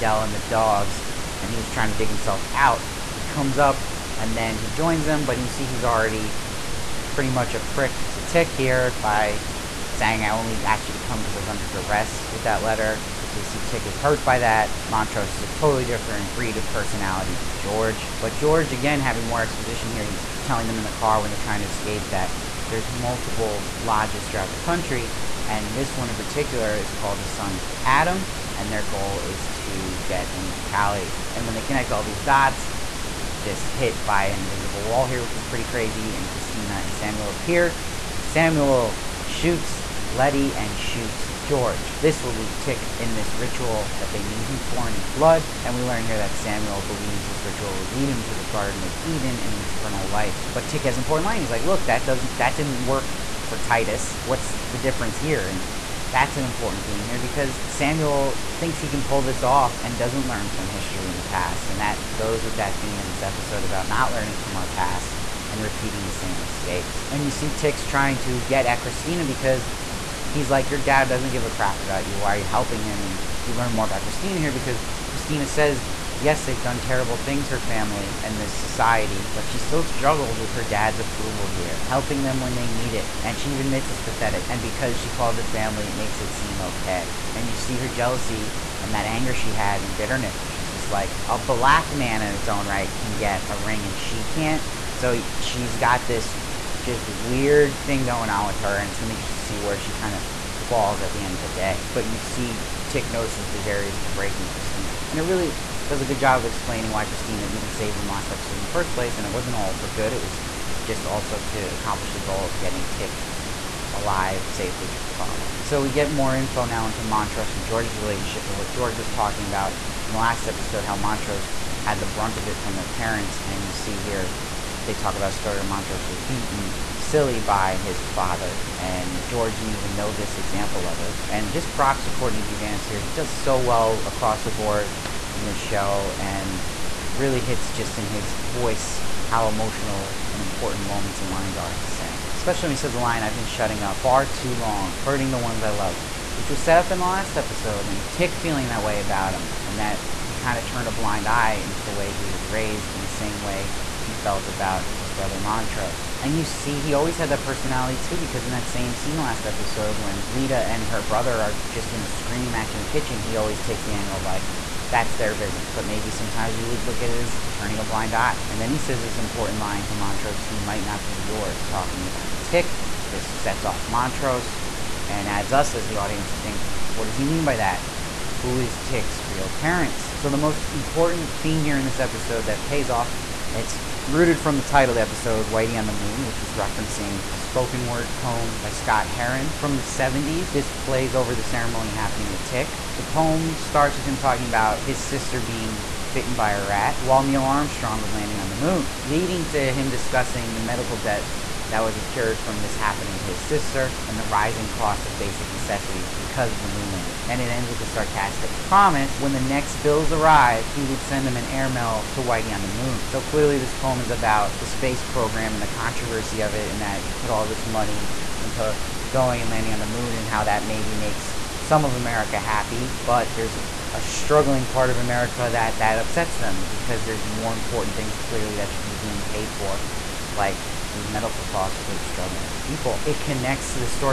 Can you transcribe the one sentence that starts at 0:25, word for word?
And this one in particular is called the Sons of Adam.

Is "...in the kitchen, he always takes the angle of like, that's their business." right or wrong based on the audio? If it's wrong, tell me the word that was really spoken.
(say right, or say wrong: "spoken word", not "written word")
right.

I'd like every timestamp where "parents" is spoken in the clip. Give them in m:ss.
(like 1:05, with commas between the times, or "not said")
2:02, 2:59.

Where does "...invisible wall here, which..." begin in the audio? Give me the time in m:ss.
0:34.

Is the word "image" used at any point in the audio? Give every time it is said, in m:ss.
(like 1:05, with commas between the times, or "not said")
not said.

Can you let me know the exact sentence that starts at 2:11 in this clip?
And just props to Courtney B.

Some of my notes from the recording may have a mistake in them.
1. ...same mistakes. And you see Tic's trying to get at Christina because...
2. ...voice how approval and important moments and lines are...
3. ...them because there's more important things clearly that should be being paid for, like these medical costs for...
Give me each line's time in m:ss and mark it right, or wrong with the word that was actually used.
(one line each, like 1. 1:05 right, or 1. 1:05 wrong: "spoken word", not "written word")
1. 1:06 right
2. 2:18 wrong: "emotional", not "approval"
3. 3:46 right.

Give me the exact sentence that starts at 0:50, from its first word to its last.
But Tic has an important line.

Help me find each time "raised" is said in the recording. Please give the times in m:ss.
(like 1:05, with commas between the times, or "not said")
2:32.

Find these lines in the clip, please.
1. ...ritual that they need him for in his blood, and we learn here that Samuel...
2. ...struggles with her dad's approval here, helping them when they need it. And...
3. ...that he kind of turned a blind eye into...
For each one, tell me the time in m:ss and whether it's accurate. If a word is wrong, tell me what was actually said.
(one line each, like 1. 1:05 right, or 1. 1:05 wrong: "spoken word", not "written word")
1. 0:43 right
2. 1:19 right
3. 2:29 right.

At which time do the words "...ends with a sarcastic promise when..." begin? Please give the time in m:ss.
3:27.